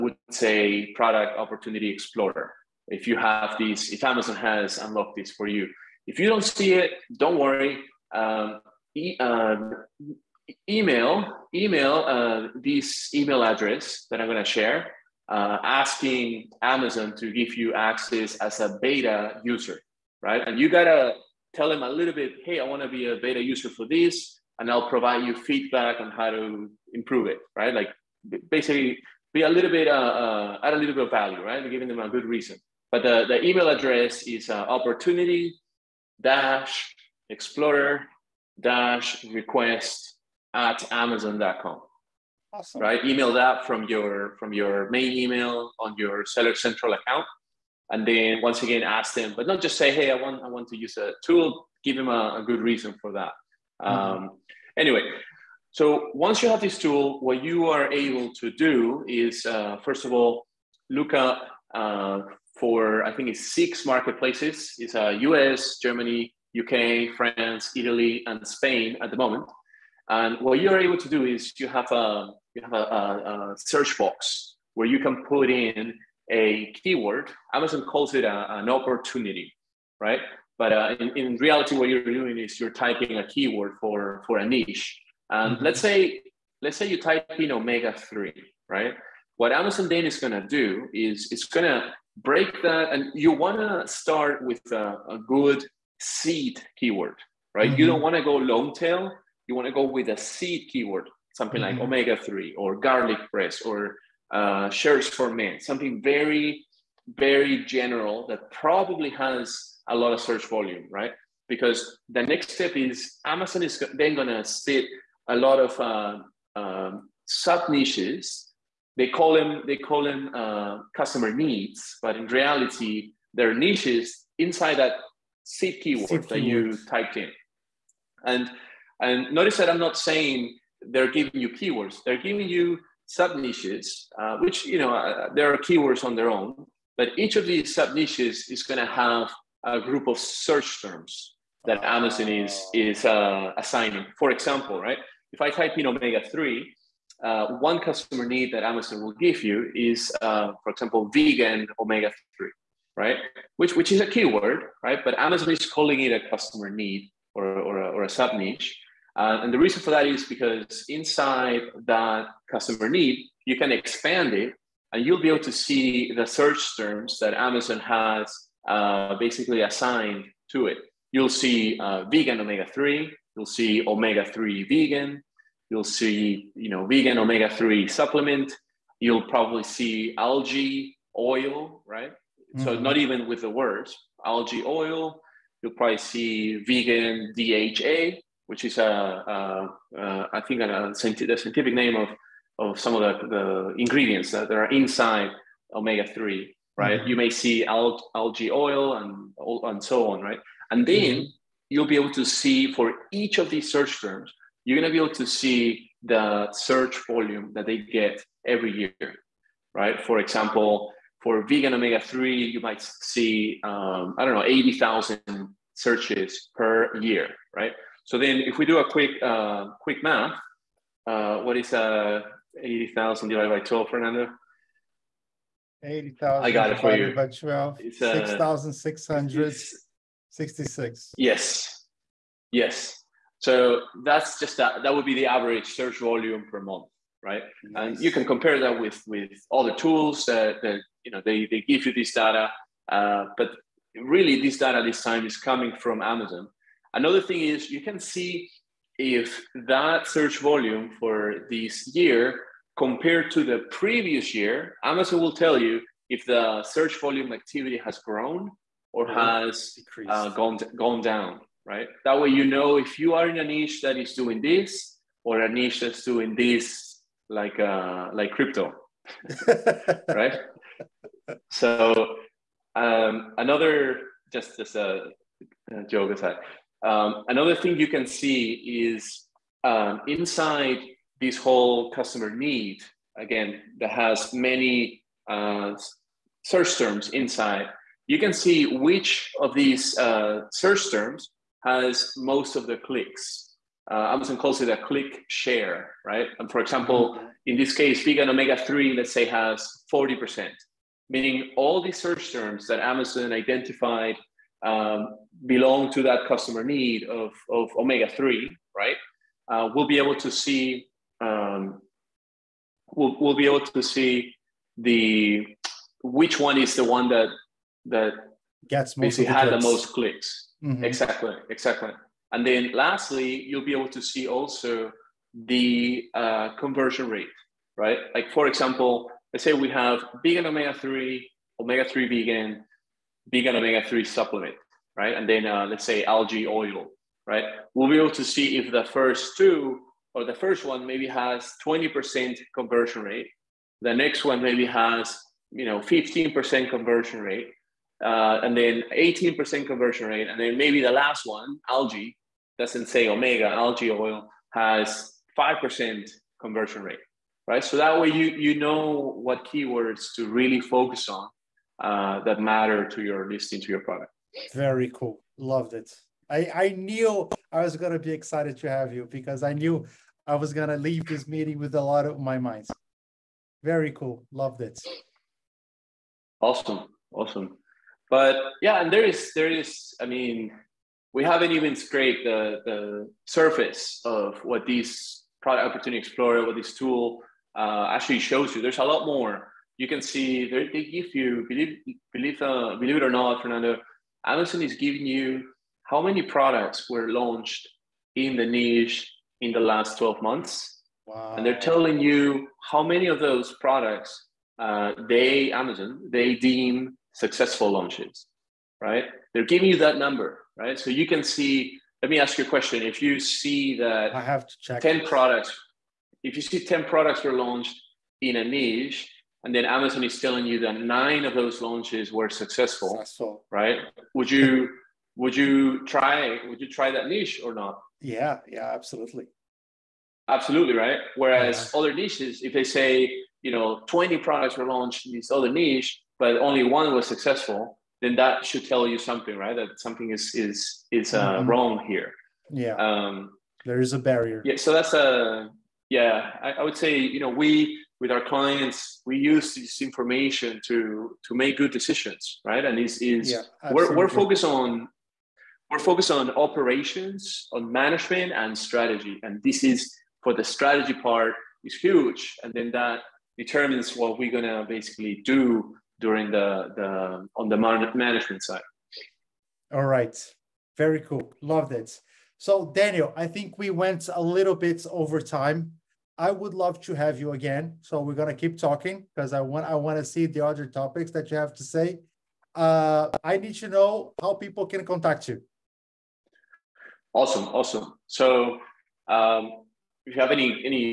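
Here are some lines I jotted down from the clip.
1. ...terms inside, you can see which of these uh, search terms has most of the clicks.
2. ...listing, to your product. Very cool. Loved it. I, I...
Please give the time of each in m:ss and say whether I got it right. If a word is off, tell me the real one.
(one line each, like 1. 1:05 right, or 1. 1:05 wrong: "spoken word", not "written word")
1. 4:46 right
2. 6:03 right.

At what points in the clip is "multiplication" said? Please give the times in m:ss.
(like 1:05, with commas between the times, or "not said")
not said.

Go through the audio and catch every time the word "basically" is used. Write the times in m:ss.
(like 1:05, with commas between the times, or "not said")
0:28, 2:49, 5:18, 7:44.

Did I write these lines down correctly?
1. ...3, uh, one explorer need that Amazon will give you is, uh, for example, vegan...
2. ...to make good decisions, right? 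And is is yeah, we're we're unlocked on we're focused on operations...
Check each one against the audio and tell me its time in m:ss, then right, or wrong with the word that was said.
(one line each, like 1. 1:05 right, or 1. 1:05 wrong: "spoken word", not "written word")
1. 2:26 wrong: "customer", not "explorer"
2. 7:31 wrong: "focused", not "unlocked".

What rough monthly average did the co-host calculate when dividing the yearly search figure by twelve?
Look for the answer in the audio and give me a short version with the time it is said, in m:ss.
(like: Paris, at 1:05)
6,600, at 3:48.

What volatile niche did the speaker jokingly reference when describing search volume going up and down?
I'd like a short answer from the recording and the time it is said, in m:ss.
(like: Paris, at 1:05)
crypto, at 4:28.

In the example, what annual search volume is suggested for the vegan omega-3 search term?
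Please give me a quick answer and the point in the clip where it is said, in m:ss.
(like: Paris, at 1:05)
80,000, at 3:34.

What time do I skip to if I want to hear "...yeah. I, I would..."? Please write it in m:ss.
7:25.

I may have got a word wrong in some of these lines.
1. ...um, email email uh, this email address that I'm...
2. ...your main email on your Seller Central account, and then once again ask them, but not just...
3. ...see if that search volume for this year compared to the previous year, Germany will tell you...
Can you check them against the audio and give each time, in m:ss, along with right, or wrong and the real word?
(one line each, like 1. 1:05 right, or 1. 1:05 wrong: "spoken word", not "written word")
1. 0:09 right
2. 0:44 right
3. 4:07 wrong: "Amazon", not "Germany".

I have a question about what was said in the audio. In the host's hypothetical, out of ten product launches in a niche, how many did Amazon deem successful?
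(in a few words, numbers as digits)
9.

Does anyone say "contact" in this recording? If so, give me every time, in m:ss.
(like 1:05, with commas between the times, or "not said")
8:04.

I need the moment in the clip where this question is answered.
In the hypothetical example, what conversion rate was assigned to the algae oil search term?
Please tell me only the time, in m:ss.
5:55.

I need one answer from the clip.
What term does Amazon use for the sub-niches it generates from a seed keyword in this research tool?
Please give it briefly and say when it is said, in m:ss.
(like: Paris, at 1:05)
customer needs, at 2:00.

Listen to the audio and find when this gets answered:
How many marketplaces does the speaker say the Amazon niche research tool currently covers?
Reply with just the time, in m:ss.
1:03.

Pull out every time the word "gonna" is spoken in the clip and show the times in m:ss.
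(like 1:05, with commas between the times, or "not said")
7:44, 7:58.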